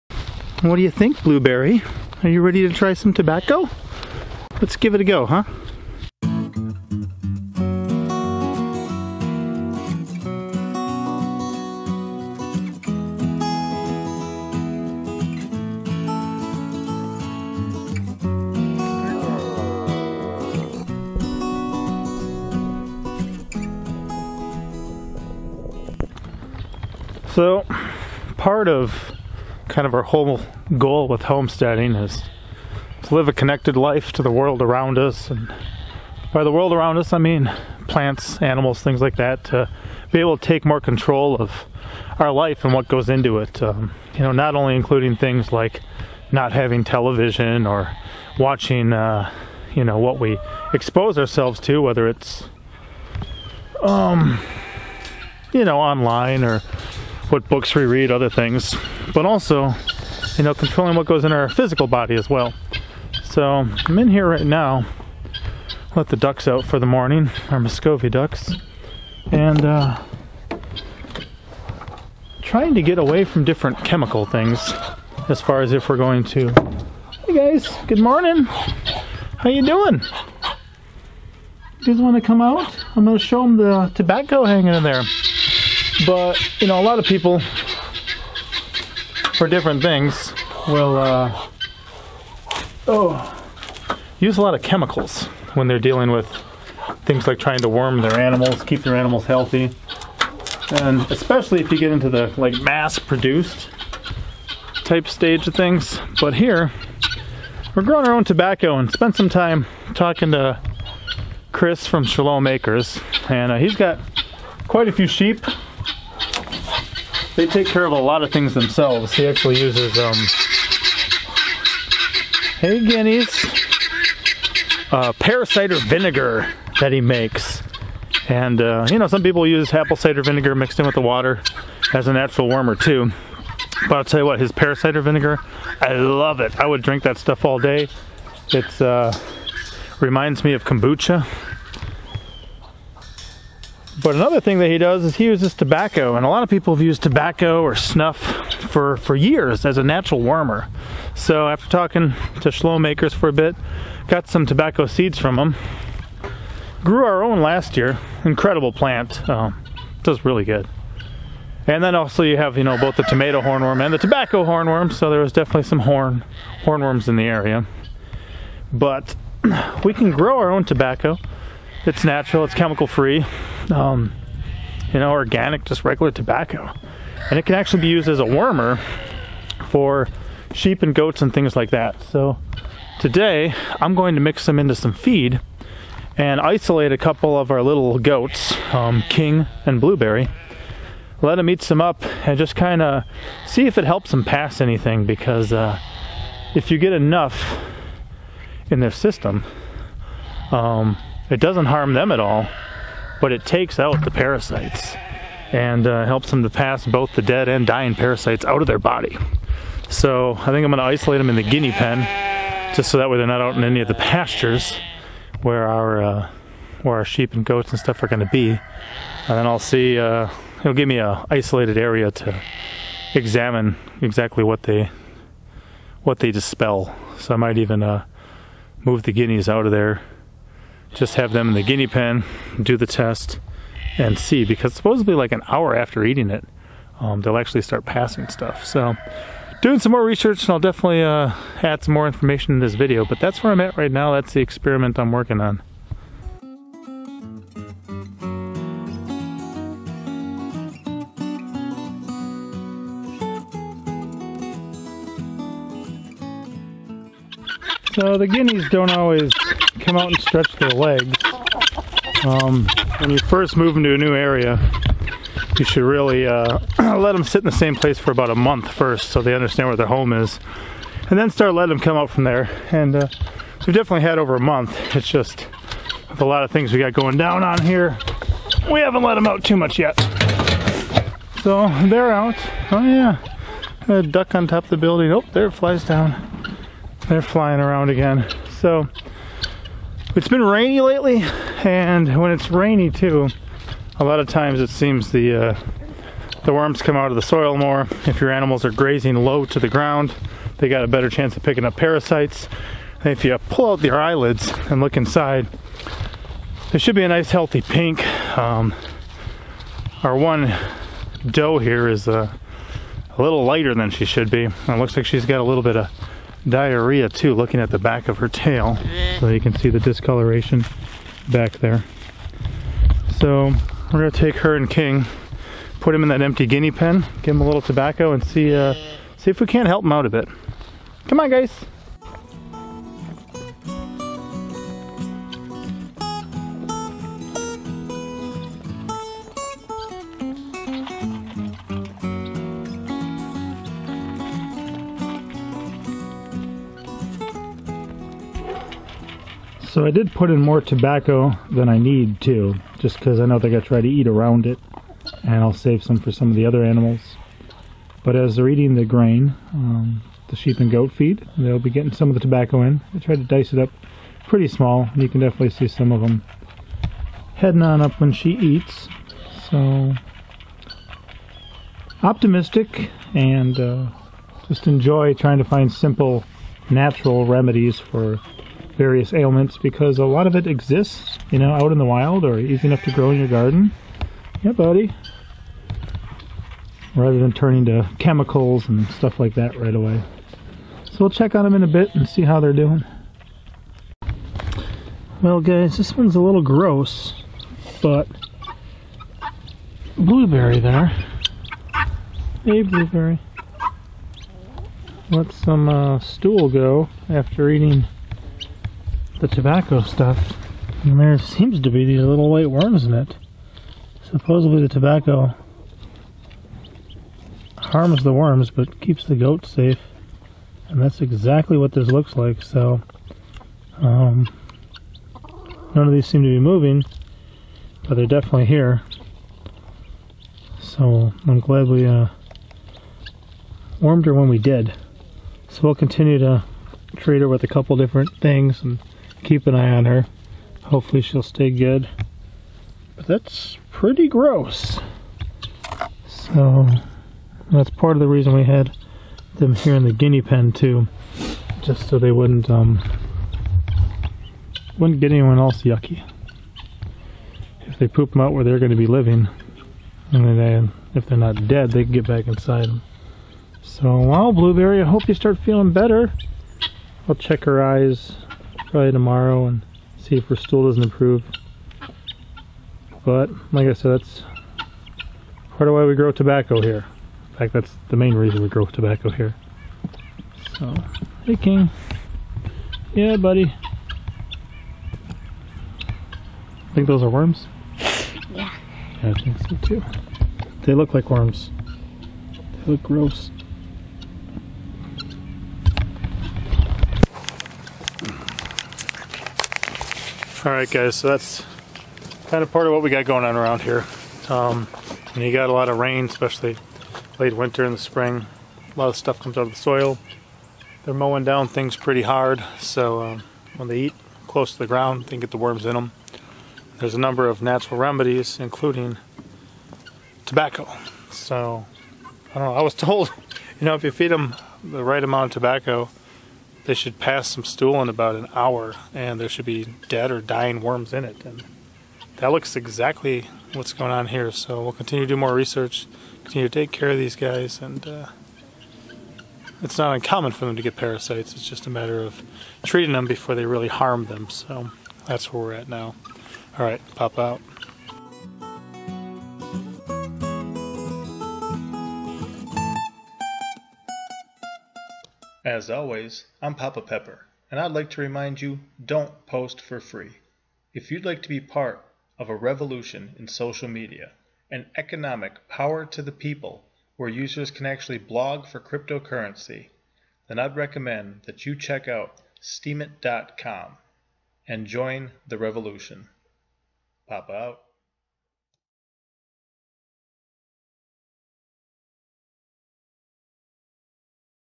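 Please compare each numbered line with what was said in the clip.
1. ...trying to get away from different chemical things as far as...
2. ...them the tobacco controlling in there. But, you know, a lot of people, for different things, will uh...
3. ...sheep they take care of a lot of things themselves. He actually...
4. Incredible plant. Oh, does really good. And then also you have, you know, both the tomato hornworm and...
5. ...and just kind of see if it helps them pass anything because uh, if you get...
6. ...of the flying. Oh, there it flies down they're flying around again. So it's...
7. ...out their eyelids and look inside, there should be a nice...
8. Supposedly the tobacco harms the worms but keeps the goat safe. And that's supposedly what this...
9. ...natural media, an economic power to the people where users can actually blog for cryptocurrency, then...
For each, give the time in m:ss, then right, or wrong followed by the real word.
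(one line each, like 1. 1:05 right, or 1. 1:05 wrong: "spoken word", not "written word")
1. 1:12 right
2. 1:23 wrong: "hanging", not "controlling"
3. 1:55 right
4. 2:38 right
5. 3:12 right
6. 4:44 wrong: "building", not "flying"
7. 5:03 right
8. 6:54 wrong: "exactly", not "supposedly"
9. 9:23 wrong: "social", not "natural".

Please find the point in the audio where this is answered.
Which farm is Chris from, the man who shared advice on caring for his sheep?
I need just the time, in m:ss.
1:52.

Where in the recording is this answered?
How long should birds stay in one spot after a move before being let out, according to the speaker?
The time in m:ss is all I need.
4:28.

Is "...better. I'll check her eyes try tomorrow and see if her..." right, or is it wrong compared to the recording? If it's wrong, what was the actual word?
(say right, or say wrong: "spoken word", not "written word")
right.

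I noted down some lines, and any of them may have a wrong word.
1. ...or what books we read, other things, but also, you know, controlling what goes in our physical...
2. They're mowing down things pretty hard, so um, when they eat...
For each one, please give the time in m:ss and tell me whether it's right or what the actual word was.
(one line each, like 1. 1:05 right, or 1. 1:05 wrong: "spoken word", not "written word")
1. 0:56 right
2. 8:30 right.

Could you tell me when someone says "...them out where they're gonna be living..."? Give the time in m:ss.
7:38.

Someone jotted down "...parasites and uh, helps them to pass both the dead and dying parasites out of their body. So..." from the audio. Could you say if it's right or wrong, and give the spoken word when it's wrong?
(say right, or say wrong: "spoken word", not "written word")
right.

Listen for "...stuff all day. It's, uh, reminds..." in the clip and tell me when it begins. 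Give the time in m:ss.
2:17.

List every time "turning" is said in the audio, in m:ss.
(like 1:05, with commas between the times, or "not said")
6:27.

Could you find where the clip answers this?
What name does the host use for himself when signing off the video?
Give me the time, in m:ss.
9:16.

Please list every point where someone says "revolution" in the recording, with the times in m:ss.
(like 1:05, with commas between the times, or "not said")
9:22, 9:35.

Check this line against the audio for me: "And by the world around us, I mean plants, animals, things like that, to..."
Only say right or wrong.
right.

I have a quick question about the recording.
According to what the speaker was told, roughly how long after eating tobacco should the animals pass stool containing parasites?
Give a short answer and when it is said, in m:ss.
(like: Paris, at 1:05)
About an hour, at 8:47.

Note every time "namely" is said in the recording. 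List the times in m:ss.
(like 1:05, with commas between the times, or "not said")
not said.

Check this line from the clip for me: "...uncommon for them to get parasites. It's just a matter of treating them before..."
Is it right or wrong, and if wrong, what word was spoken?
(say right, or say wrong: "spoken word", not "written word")
right.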